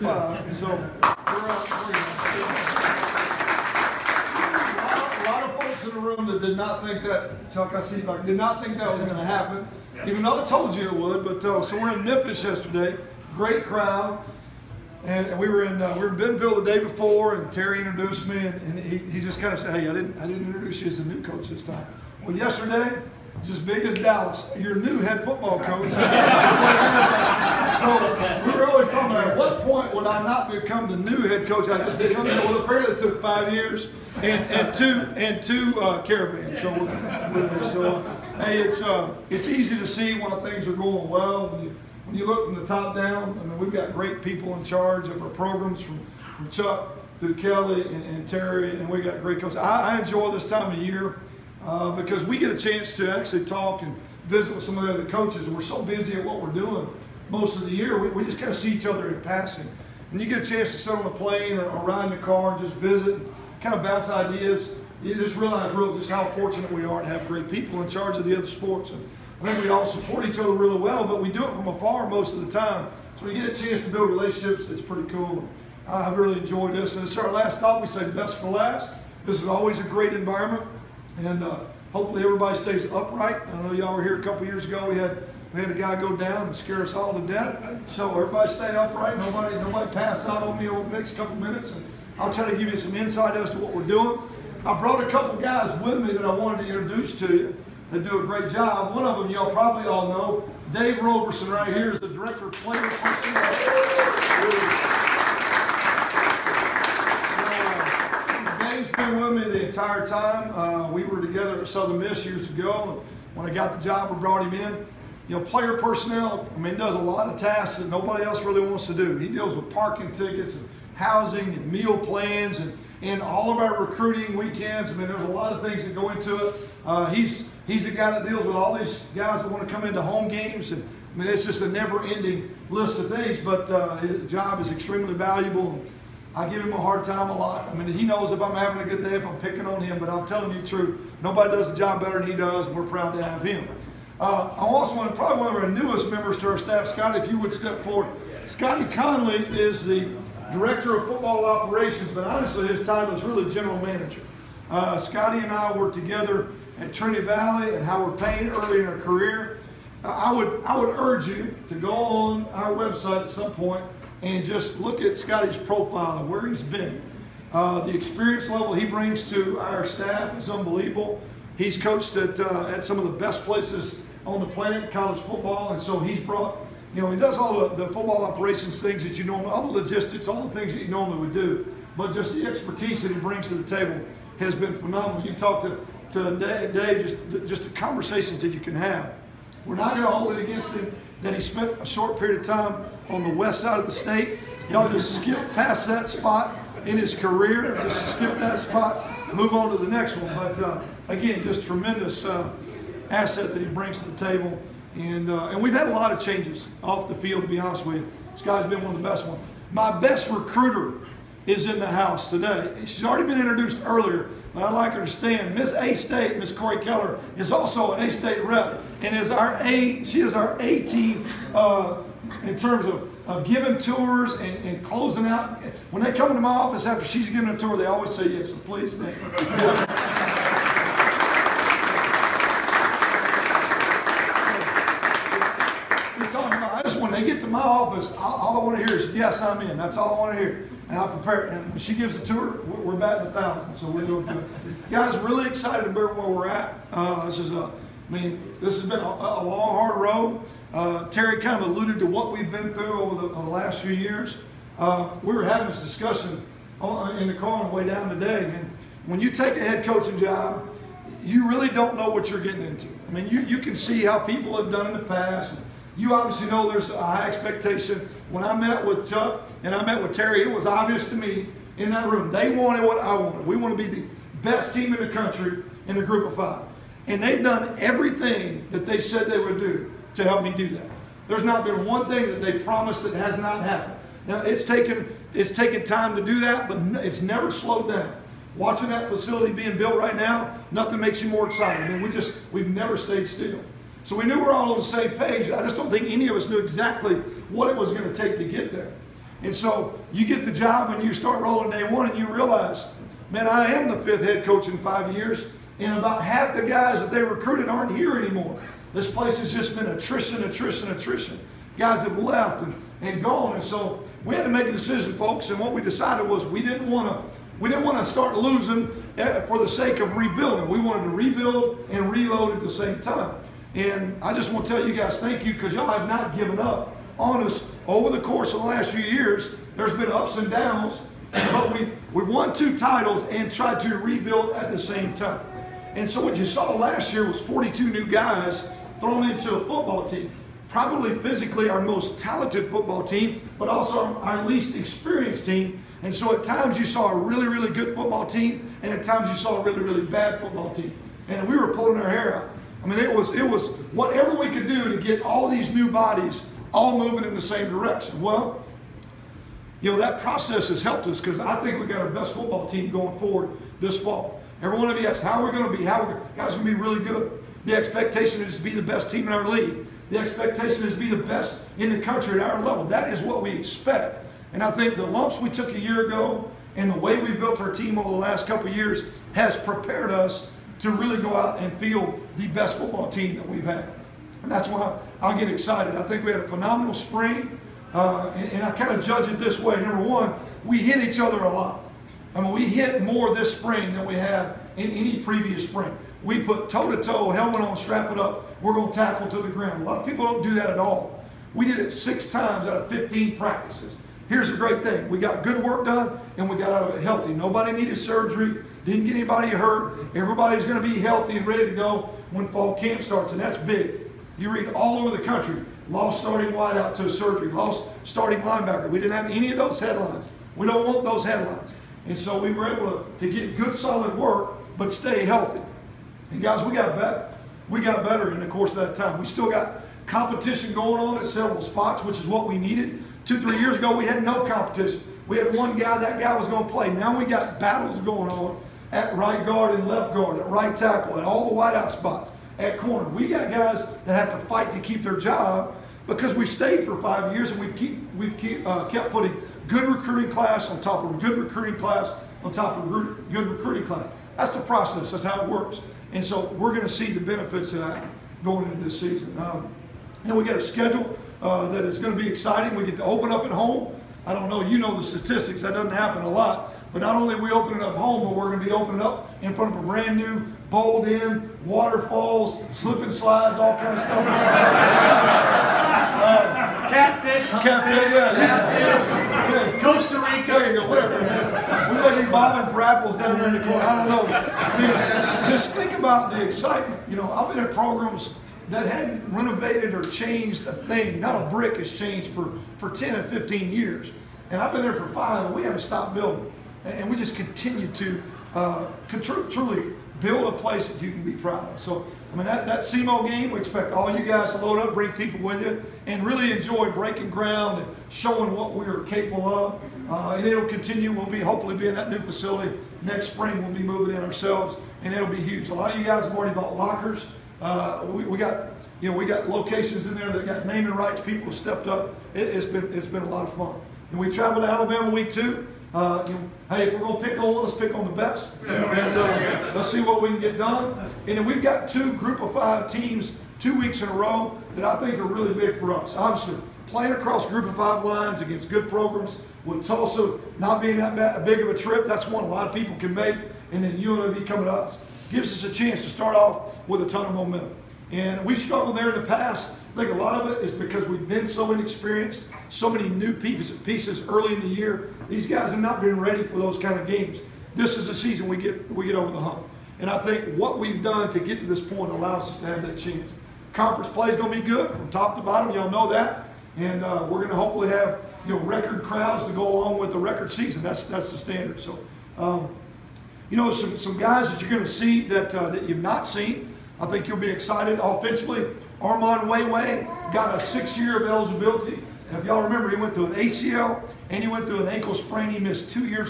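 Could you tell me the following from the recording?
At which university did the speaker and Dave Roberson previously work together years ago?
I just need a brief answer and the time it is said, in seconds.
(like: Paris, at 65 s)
Southern Miss, at 111 s.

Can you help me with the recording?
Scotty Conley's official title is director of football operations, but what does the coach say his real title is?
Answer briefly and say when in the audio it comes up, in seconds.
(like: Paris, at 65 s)
General manager, at 153 s.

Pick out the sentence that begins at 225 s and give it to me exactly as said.
When they come into my office after she's given a tour, they always say yes, so please.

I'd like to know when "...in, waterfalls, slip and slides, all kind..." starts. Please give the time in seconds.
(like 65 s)
471 s.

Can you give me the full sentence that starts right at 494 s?
And I've been there for five, and we haven't stopped building.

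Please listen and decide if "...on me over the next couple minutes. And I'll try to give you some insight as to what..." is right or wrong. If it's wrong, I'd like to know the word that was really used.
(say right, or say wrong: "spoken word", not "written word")
right.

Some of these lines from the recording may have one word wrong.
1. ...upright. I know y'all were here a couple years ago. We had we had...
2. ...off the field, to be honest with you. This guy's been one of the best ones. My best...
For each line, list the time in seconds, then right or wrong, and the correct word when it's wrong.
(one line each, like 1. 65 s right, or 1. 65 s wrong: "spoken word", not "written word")
1. 82 s right
2. 206 s right.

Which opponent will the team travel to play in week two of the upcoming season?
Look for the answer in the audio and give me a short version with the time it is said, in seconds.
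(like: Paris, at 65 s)
Alabama, at 524 s.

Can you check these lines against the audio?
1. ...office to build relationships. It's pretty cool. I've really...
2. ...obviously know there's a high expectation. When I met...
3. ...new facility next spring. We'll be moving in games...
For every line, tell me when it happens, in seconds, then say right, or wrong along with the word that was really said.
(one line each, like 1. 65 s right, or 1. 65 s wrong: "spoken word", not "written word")
1. 73 s wrong: "chance", not "office"
2. 266 s right
3. 512 s wrong: "ourselves", not "games".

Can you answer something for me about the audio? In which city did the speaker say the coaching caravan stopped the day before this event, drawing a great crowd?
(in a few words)
Memphis.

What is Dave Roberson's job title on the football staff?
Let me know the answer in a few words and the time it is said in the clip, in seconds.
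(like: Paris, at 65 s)
Director of player personnel, at 102 s.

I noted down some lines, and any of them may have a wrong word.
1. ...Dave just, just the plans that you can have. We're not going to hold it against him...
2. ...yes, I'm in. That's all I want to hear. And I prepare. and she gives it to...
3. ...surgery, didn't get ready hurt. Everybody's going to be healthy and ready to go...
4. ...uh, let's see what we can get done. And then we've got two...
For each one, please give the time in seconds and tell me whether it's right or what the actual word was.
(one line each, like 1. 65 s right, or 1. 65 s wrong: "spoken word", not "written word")
1. 186 s wrong: "conversations", not "plans"
2. 239 s right
3. 407 s wrong: "anybody", not "ready"
4. 528 s right.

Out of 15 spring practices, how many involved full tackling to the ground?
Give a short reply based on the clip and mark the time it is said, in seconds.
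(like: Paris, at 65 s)
6, at 401 s.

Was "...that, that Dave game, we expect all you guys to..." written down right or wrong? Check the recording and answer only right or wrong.
wrong.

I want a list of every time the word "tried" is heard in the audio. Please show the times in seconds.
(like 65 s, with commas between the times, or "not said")
333 s.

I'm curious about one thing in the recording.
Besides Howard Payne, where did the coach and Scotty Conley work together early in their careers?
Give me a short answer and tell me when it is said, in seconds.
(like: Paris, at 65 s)
Trinity Valley, at 156 s.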